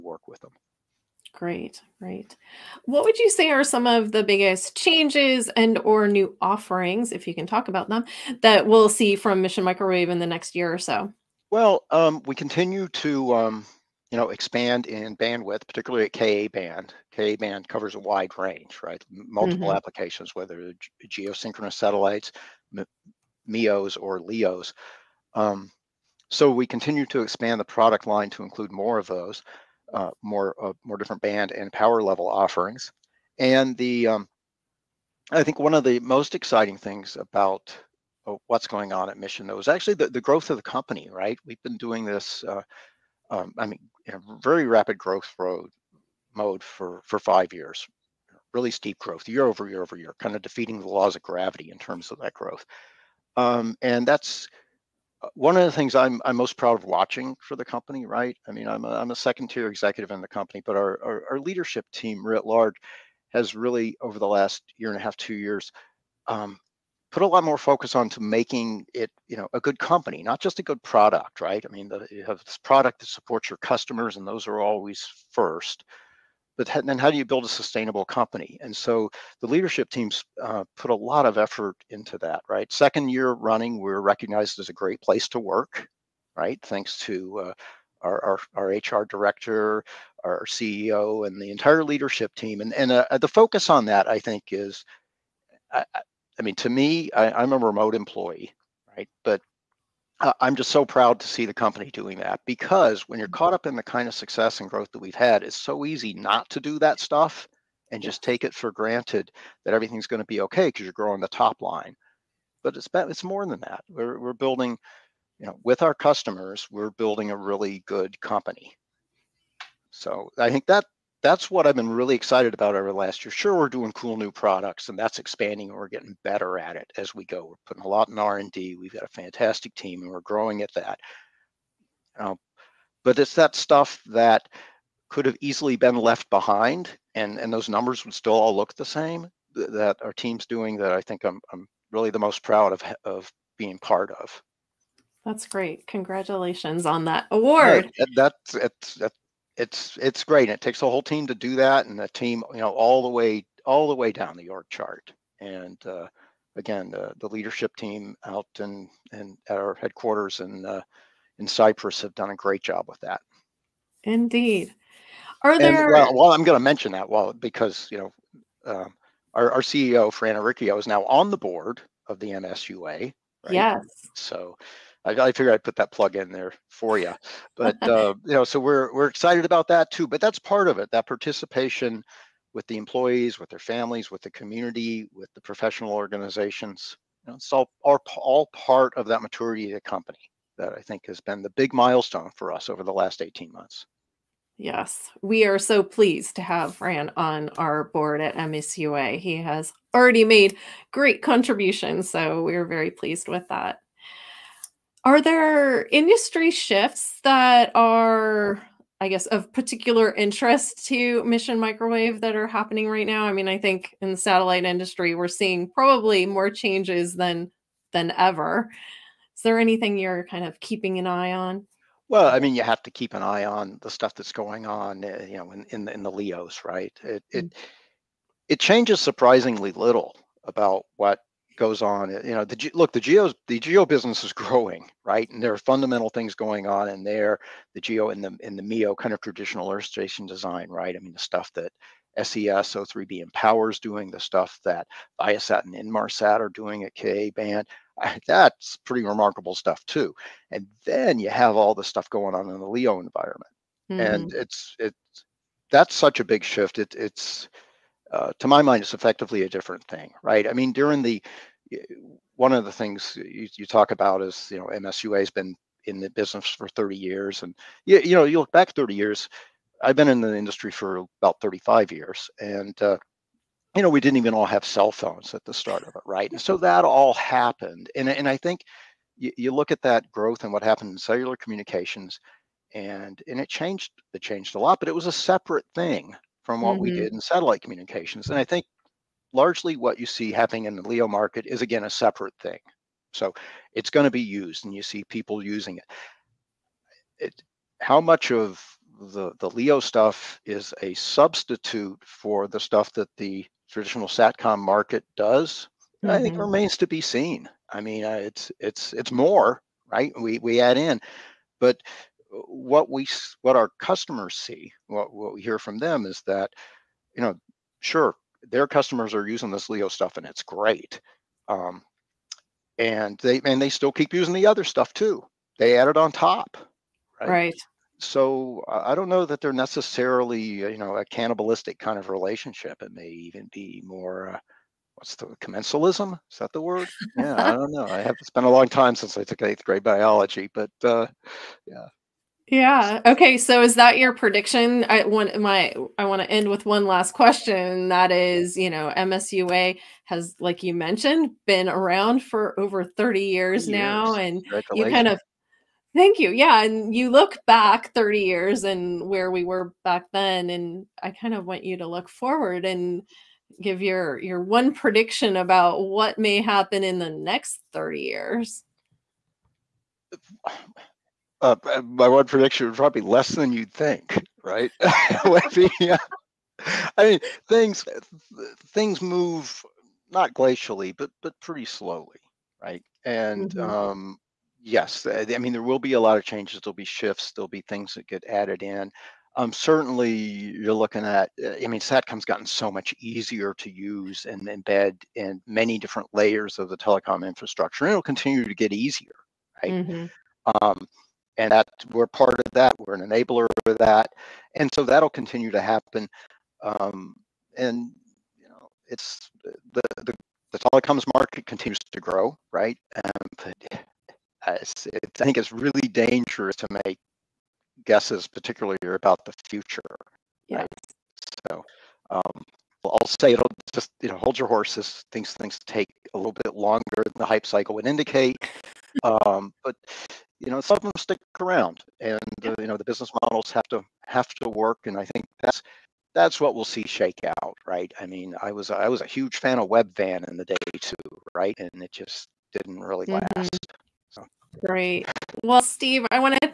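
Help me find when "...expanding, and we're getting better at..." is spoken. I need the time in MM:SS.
02:05.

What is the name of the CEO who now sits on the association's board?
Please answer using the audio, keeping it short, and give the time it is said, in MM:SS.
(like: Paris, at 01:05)
Fran Auricchio, at 02:50.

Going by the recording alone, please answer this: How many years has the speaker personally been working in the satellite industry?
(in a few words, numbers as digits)
About 35 years.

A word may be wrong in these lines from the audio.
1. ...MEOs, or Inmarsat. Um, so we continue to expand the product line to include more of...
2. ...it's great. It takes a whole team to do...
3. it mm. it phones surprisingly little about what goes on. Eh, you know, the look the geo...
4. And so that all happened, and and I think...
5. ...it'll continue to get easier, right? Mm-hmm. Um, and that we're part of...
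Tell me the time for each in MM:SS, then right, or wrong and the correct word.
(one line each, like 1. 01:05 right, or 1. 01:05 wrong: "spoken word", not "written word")
1. 00:23 wrong: "LEOs", not "Inmarsat"
2. 02:29 right
3. 03:47 wrong: "changes", not "phones"
4. 04:36 right
5. 06:37 right.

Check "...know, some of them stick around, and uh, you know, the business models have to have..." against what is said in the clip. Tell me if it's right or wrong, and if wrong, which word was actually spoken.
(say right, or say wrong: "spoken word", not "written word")
right.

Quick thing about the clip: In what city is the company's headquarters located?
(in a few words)
Cypress.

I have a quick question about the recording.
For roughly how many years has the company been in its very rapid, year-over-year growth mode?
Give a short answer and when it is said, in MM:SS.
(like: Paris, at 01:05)
5 years, at 00:47.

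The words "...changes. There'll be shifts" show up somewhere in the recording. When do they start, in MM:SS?
06:26.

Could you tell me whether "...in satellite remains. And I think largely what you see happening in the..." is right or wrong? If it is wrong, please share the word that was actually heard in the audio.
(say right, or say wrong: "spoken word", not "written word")
wrong: "communications", not "remains".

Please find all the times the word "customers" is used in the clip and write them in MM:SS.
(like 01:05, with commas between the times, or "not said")
01:13, 01:55, 05:13, 05:18.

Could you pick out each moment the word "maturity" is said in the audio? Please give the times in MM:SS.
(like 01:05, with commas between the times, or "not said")
03:09.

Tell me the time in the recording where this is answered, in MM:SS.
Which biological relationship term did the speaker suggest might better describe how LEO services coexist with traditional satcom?
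05:35.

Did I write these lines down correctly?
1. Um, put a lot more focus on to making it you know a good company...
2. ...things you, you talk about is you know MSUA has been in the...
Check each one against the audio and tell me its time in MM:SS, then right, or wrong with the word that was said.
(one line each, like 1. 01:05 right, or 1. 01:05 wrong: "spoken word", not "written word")
1. 01:06 right
2. 04:22 right.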